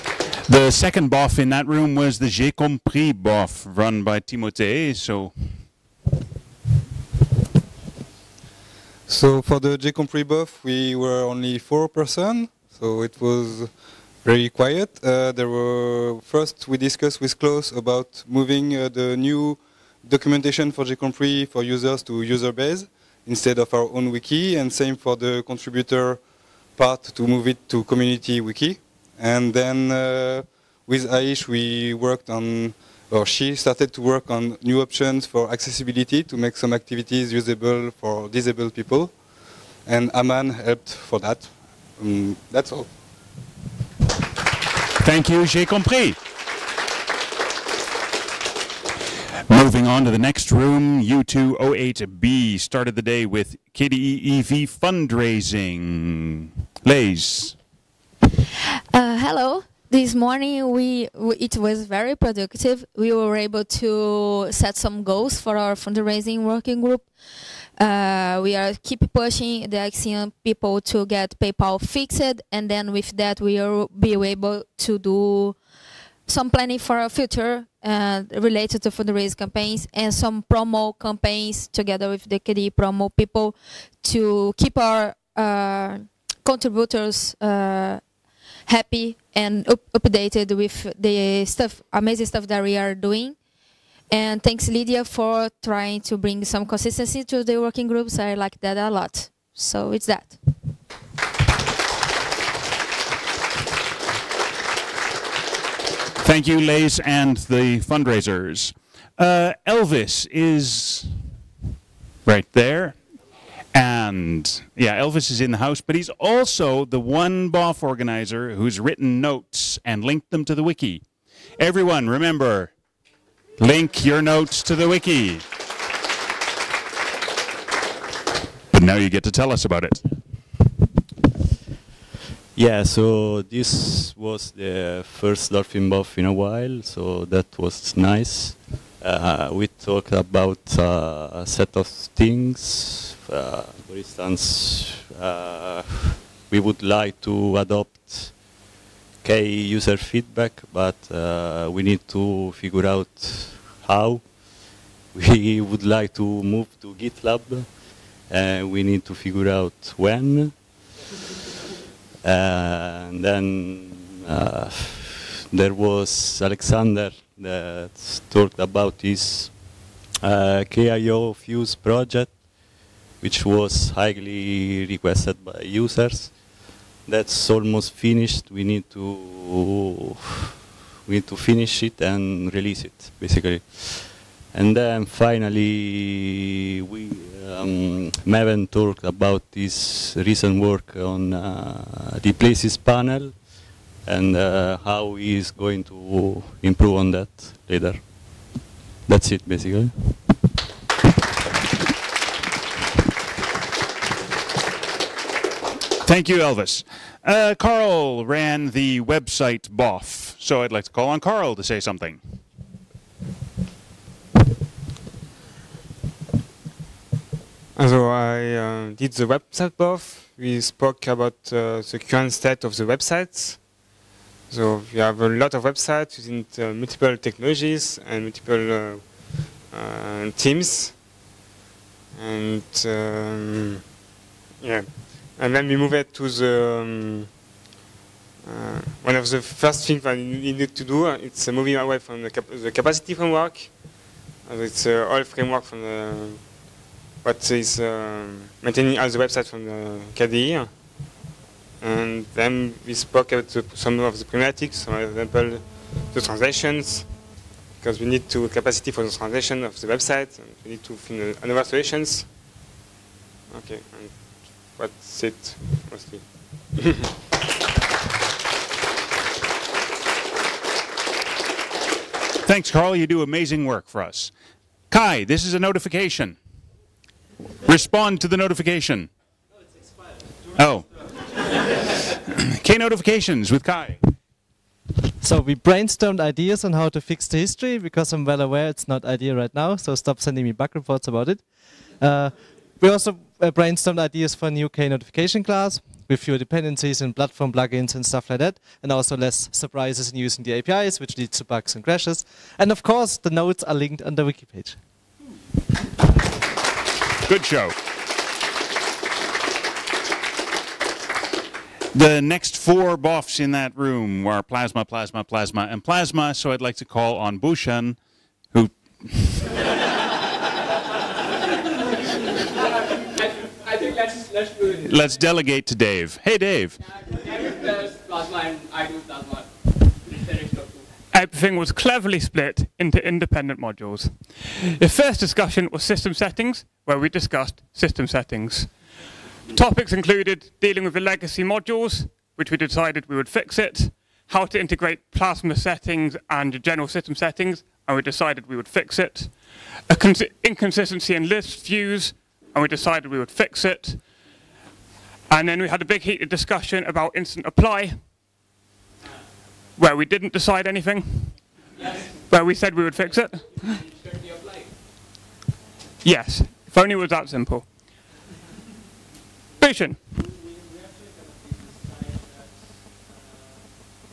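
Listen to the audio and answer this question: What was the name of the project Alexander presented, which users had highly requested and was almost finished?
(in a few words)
KIO Fuse.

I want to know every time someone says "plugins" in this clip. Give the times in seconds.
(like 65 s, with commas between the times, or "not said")
297 s.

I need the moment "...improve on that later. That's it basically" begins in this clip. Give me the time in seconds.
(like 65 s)
196 s.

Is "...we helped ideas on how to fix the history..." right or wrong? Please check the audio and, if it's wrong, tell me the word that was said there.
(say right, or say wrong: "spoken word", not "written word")
wrong: "brainstormed", not "helped".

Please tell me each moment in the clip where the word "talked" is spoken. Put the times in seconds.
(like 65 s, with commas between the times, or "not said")
139 s, 168 s, 188 s.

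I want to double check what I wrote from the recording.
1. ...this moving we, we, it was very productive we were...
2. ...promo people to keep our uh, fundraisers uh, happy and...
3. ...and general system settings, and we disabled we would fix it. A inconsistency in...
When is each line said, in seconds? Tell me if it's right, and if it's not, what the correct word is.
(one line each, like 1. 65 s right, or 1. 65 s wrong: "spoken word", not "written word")
1. 59 s wrong: "morning", not "moving"
2. 82 s wrong: "contributors", not "fundraisers"
3. 346 s wrong: "decided", not "disabled".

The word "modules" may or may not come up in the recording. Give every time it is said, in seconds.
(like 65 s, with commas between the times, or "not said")
333 s, 341 s.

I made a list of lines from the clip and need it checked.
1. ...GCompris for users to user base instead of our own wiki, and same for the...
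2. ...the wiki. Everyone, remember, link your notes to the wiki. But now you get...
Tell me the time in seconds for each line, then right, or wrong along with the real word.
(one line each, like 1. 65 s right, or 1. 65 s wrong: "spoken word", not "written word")
1. 20 s right
2. 120 s right.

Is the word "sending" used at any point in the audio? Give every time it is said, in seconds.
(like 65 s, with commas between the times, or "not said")
290 s.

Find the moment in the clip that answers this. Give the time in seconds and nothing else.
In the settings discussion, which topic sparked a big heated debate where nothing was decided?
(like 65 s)
357 s.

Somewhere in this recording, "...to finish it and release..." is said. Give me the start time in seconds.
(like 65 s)
181 s.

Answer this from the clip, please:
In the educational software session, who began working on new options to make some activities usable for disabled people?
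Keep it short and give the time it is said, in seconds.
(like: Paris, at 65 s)
Aish, at 31 s.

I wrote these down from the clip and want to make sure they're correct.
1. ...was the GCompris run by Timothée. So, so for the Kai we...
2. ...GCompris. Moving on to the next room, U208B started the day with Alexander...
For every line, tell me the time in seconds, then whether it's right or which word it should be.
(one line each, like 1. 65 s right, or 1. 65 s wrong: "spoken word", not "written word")
1. 1 s wrong: "GCompris", not "Kai"
2. 45 s wrong: "KDE", not "Alexander".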